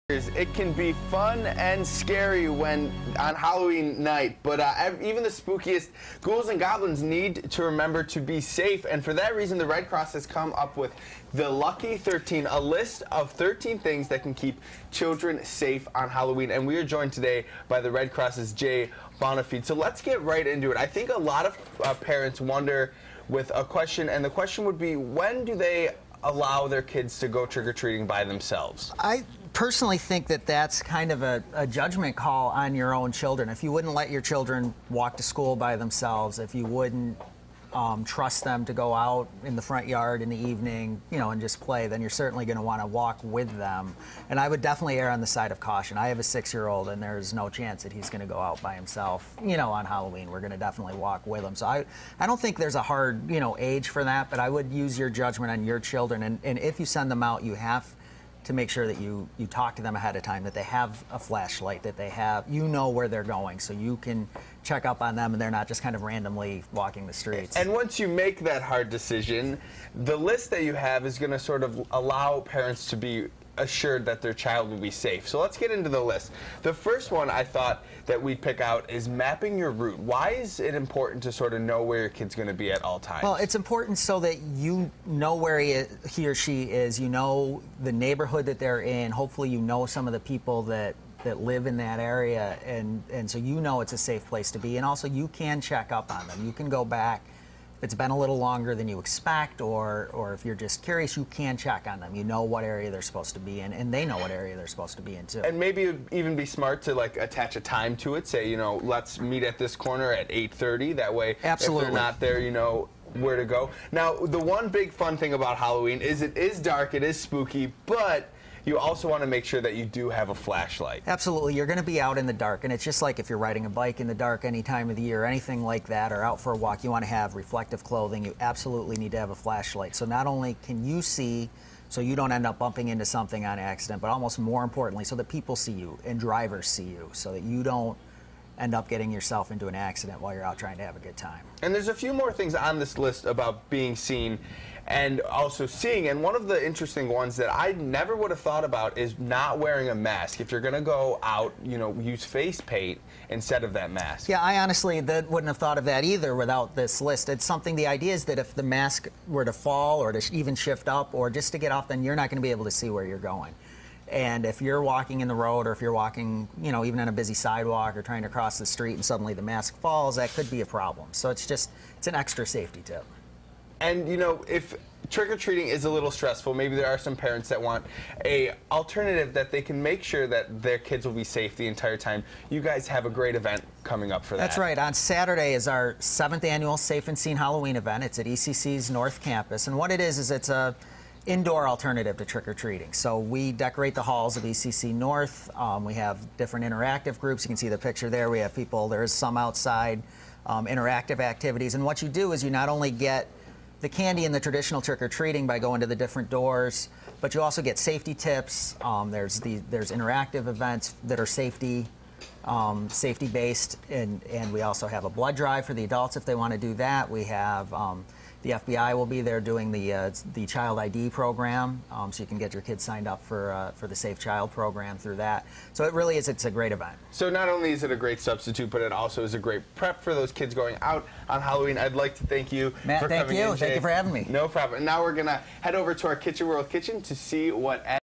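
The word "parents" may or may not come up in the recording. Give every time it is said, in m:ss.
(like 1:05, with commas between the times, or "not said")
0:21, 1:12, 2:57.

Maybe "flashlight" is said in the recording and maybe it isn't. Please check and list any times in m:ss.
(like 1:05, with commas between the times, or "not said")
1:01, 2:00, 2:09.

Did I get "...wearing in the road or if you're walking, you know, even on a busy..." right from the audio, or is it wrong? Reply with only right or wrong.
wrong.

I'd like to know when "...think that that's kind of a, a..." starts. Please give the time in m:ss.
0:29.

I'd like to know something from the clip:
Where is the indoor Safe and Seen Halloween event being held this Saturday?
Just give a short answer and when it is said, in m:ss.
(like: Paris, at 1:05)
ECC's North Campus, at 3:08.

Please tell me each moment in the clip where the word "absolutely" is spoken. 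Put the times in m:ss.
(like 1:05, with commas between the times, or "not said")
1:51, 2:01, 2:08.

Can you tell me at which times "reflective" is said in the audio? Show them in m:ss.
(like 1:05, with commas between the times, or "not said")
2:07.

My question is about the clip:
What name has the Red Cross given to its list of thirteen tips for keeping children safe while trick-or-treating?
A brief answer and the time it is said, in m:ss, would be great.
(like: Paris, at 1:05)
Lucky 13, at 0:11.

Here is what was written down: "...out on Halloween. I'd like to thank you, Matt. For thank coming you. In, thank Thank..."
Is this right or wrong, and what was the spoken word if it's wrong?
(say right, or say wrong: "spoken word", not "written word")
right.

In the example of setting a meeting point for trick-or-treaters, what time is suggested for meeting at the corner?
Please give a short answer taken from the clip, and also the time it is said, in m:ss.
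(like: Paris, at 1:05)
8:30, at 1:50.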